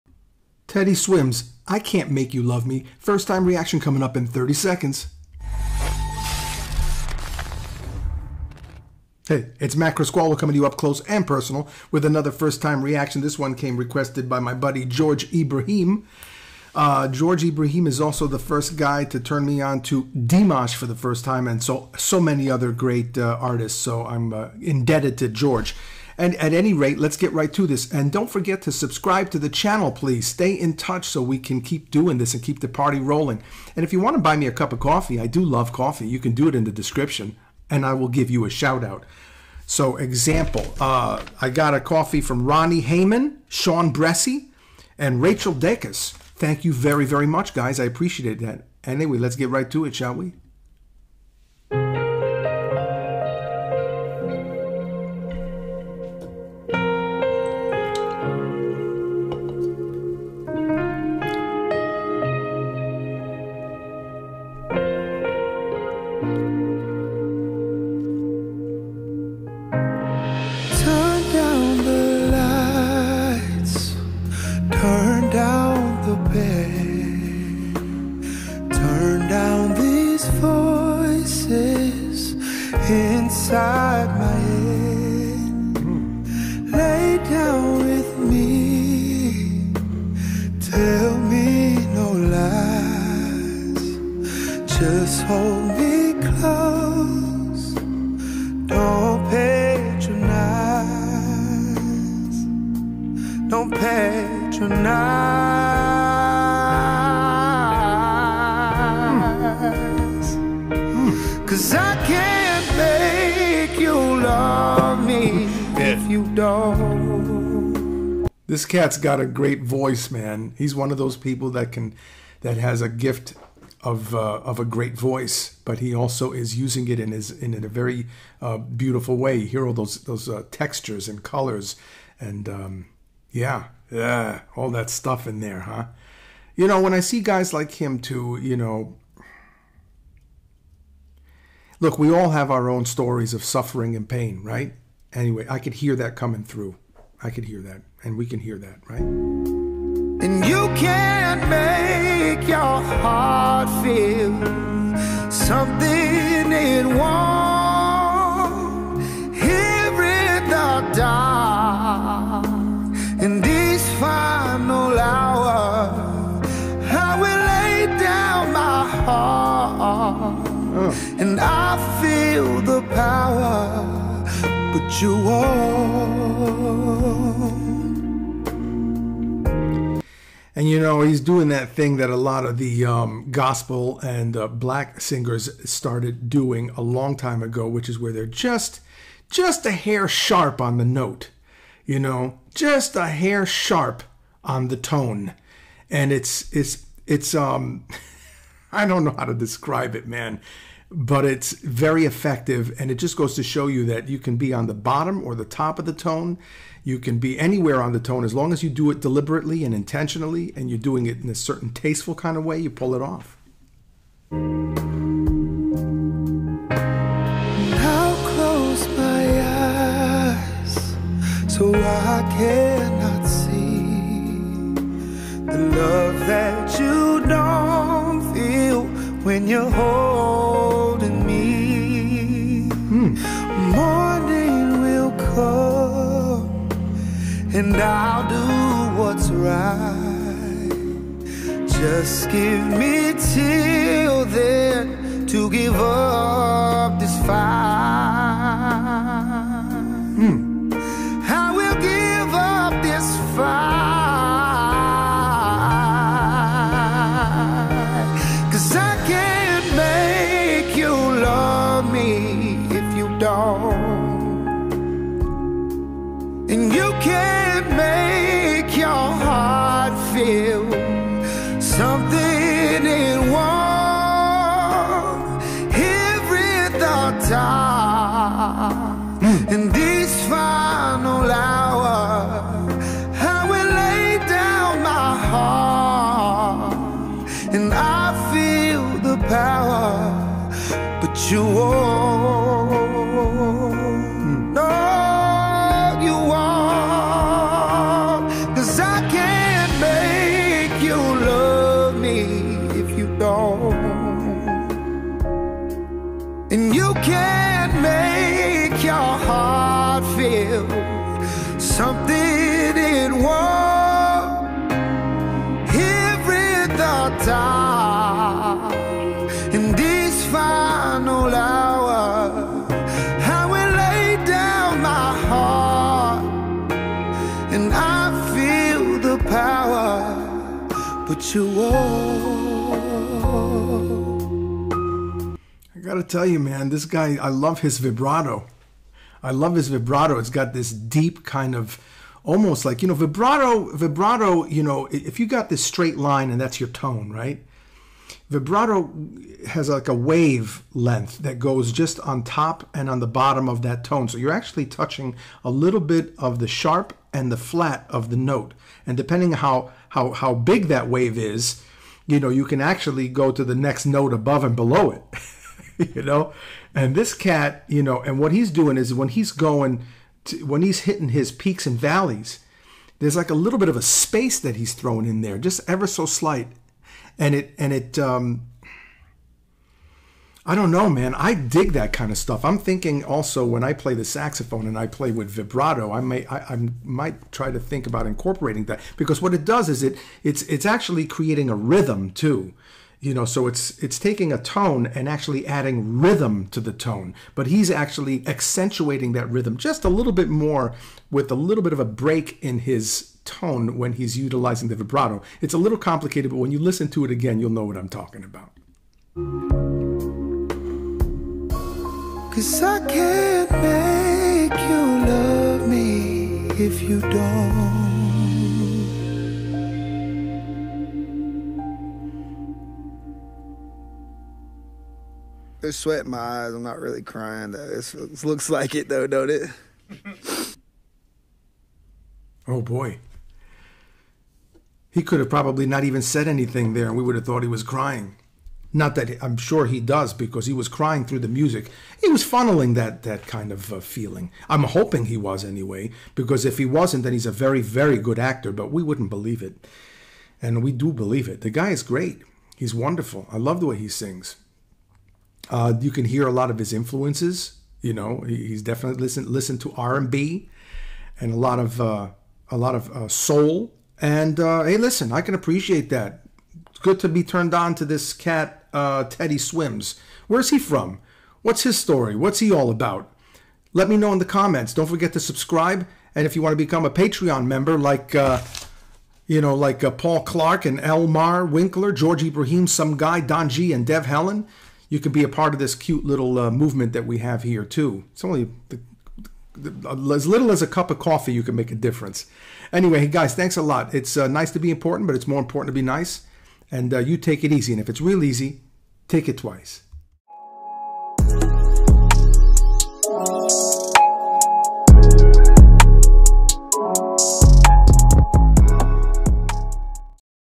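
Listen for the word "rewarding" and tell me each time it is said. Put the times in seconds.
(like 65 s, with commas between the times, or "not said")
not said.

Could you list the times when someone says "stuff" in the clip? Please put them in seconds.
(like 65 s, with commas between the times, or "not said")
134 s, 382 s.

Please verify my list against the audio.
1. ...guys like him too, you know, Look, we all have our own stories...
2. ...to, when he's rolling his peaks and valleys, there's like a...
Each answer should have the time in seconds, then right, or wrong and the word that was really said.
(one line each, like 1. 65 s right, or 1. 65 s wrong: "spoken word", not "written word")
1. 137 s right
2. 370 s wrong: "hitting", not "rolling".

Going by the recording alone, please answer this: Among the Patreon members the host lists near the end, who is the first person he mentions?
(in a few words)
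Paul Clark.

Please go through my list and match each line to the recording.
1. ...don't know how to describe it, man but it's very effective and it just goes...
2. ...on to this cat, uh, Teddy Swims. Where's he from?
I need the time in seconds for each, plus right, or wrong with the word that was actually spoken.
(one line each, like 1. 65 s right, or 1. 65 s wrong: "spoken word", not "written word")
1. 198 s right
2. 467 s right.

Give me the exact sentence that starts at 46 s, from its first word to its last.
Thank you very, very much, guys.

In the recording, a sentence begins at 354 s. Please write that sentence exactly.
So you're actually touching a little bit of the sharp and the flat of the note.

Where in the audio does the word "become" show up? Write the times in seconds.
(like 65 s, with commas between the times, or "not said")
476 s.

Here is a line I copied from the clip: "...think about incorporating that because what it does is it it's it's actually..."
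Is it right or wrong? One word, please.
right.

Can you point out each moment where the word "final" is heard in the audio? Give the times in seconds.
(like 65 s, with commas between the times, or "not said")
320 s.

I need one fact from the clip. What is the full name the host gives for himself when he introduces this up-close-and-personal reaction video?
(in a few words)
Matt Criscuolo.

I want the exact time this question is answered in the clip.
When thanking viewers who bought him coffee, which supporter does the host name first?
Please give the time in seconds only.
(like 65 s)
42 s.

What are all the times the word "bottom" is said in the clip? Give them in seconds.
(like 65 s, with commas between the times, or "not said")
204 s, 353 s.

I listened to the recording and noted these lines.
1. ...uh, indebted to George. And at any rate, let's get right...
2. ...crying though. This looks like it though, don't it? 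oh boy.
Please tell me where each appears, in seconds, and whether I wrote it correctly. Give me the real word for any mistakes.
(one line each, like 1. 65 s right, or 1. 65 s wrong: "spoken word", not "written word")
1. 24 s right
2. 427 s right.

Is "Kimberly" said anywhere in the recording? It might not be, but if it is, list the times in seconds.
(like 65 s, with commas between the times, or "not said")
not said.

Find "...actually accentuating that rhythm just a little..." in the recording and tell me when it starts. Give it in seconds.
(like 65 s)
397 s.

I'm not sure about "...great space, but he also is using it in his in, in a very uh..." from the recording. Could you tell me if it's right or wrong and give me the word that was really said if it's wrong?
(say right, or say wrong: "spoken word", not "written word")
wrong: "voice", not "space".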